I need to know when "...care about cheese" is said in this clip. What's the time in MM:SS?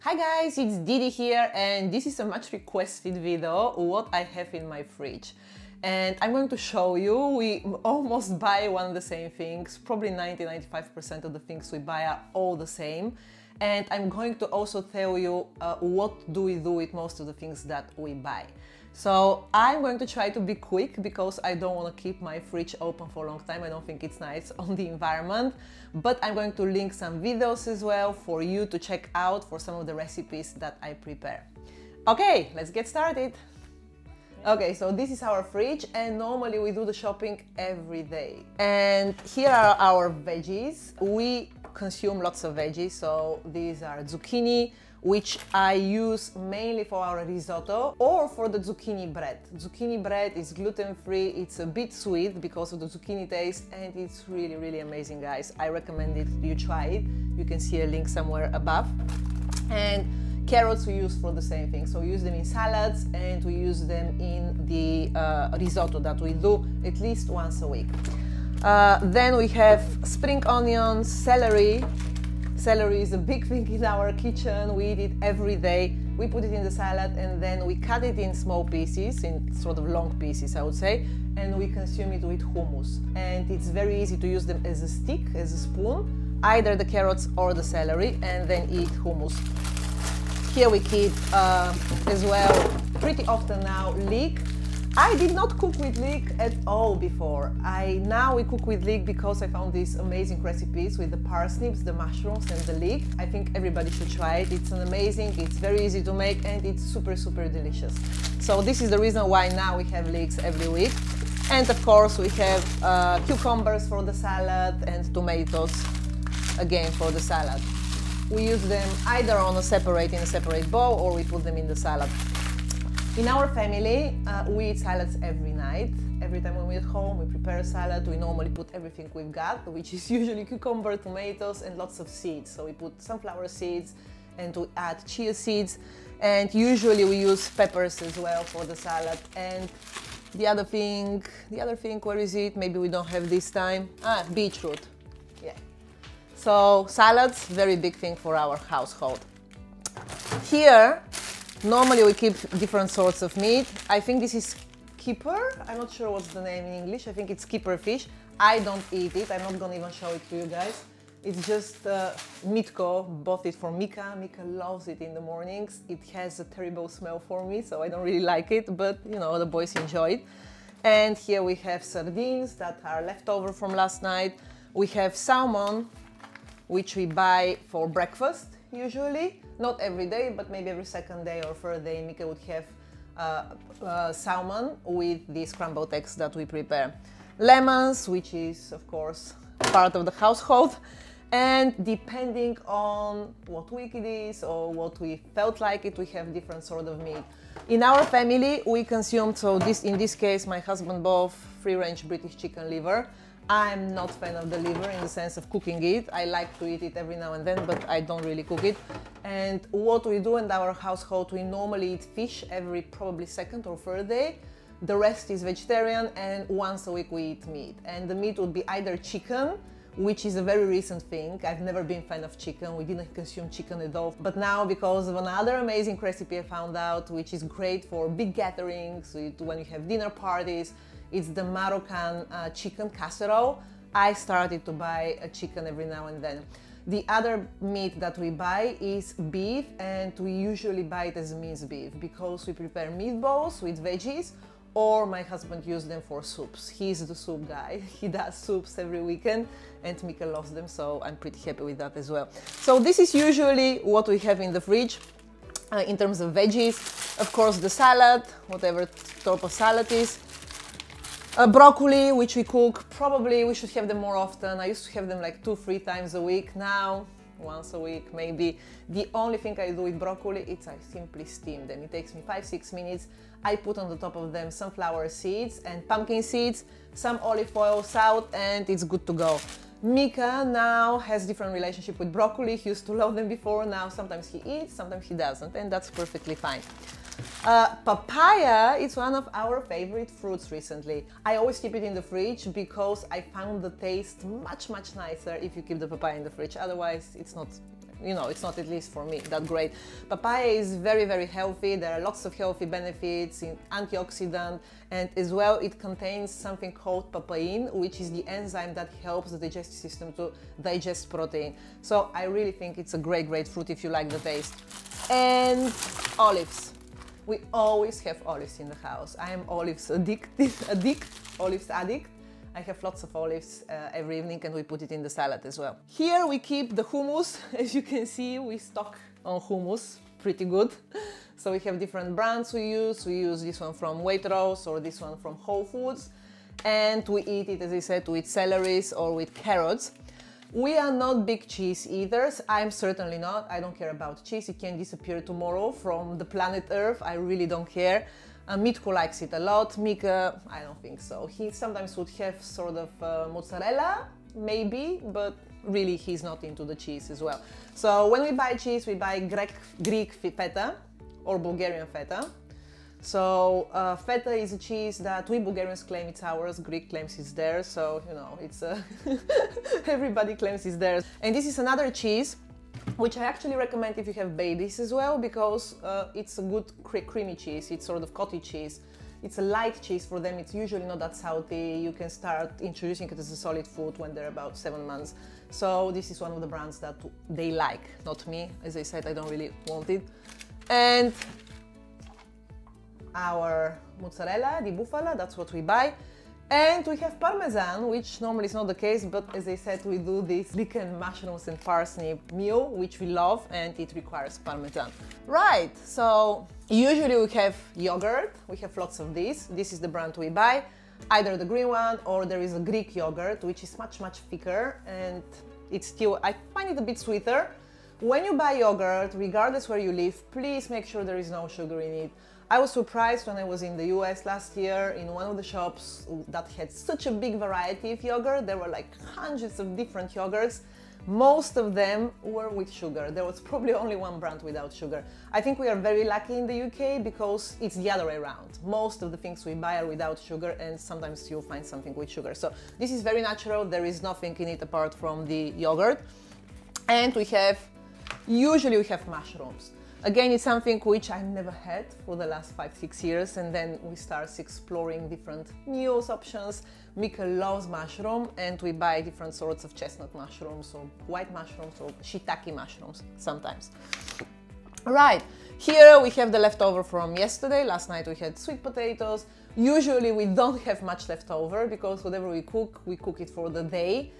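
05:43.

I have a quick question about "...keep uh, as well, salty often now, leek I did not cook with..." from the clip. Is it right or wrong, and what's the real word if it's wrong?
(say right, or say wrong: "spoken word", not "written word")
wrong: "pretty", not "salty".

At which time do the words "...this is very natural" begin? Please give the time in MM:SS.
07:22.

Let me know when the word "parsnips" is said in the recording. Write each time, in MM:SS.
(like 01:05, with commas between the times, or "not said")
01:41, 06:41.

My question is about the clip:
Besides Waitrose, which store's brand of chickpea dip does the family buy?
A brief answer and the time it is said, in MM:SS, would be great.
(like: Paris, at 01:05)
Whole Foods, at 05:35.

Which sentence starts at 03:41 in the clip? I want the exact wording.
I've never been fan of chicken.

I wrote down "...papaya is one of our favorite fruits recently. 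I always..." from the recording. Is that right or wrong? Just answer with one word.
right.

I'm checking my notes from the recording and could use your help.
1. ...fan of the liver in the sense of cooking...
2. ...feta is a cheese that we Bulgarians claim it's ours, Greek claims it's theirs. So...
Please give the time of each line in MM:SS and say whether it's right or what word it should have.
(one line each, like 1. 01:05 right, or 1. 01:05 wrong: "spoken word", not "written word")
1. 03:24 right
2. 06:03 right.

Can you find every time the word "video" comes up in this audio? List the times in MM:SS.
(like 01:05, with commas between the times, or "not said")
00:03, 00:27.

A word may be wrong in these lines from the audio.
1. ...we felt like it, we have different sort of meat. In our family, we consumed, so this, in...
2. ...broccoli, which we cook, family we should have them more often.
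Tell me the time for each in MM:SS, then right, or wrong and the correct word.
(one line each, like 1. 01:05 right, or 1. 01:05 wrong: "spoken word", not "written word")
1. 03:15 right
2. 04:21 wrong: "probably", not "family".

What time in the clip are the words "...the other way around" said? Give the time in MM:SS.
07:17.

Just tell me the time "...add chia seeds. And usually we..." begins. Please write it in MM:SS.
02:14.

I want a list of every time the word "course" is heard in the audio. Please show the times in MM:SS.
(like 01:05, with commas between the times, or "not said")
01:51, 03:08, 04:17.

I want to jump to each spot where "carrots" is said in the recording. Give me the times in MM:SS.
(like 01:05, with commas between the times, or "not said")
01:00, 01:26, 05:39.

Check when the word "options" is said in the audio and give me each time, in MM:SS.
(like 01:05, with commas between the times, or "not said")
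07:36.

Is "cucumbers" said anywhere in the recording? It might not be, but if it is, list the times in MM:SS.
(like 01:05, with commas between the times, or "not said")
01:53, 02:10.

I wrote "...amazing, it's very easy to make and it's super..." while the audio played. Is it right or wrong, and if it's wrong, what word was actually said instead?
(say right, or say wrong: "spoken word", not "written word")
right.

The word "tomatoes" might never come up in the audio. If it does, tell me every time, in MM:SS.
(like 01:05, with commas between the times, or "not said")
01:55, 02:10.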